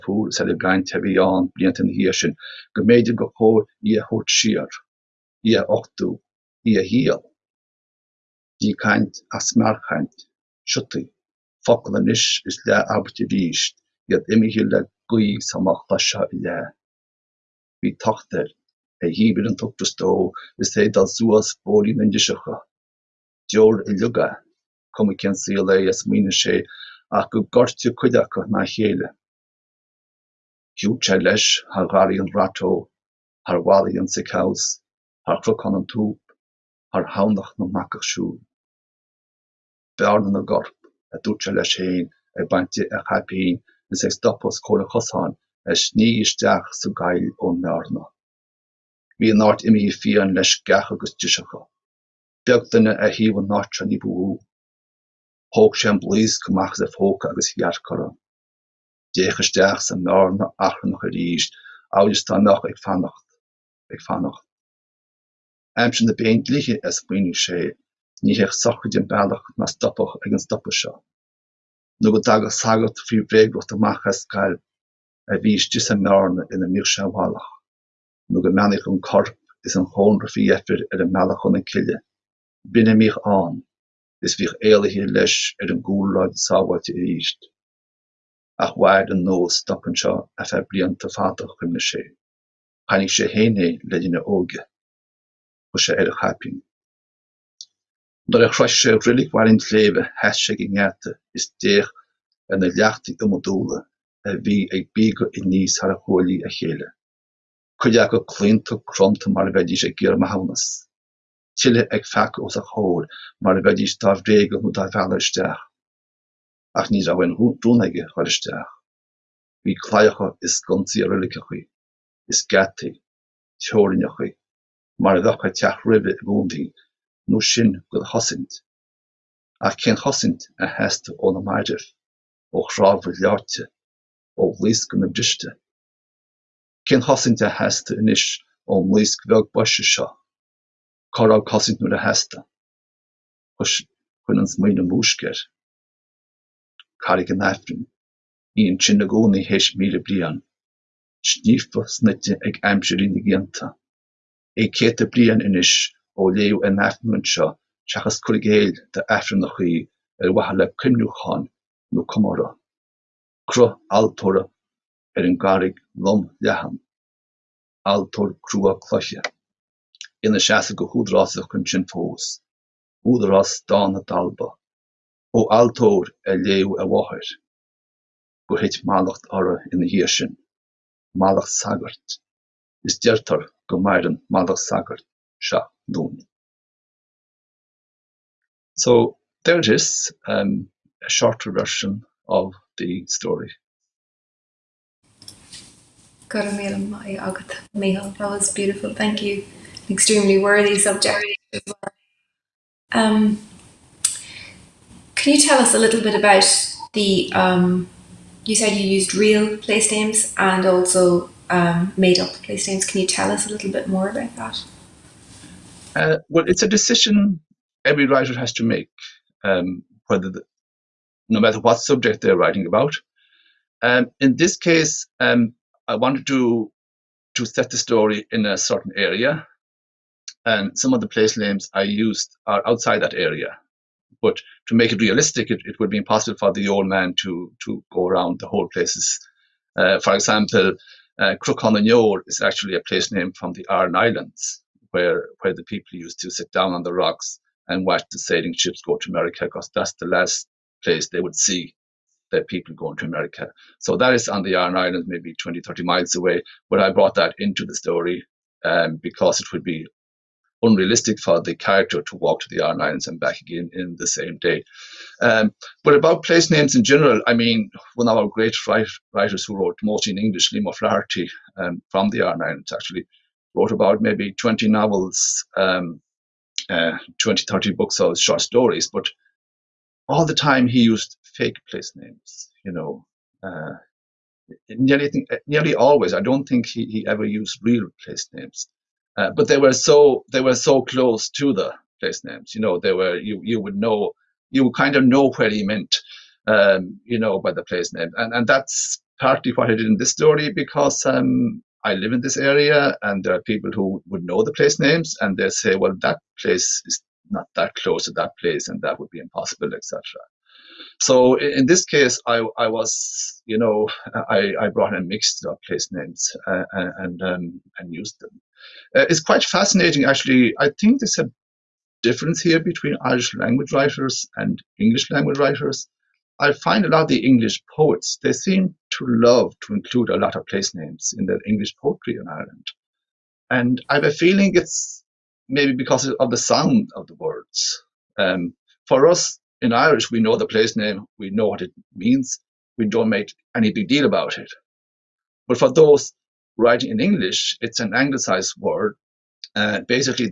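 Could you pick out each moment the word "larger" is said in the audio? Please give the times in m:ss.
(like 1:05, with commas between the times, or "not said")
not said.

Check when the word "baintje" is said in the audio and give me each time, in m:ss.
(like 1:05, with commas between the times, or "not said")
0:42.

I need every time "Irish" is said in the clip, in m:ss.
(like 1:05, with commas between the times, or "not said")
5:23, 5:39.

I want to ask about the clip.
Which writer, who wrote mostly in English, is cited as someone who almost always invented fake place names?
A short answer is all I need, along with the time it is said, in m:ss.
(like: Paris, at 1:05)
Liam O'Flaherty, at 4:30.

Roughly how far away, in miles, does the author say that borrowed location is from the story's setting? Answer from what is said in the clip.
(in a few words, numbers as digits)
20, 30 miles.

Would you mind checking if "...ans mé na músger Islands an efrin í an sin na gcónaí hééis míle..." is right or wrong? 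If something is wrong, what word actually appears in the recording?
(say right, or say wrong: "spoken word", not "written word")
wrong: "Carig", not "Islands".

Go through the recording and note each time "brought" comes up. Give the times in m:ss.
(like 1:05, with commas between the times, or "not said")
4:16, 5:14.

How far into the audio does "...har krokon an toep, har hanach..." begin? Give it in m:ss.
0:35.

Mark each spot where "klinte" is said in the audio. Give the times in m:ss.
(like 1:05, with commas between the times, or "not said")
1:48.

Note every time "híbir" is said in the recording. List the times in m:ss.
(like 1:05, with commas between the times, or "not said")
0:19.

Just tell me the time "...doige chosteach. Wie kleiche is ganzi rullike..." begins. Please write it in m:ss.
1:57.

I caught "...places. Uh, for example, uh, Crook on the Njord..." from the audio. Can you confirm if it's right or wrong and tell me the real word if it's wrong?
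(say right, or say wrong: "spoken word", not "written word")
right.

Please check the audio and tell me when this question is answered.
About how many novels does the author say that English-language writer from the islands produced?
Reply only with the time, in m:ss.
4:34.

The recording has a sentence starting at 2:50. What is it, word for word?
ina seaasa go húdrásach chun sin fós.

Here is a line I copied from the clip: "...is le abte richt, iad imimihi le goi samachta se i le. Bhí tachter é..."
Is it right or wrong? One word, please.
right.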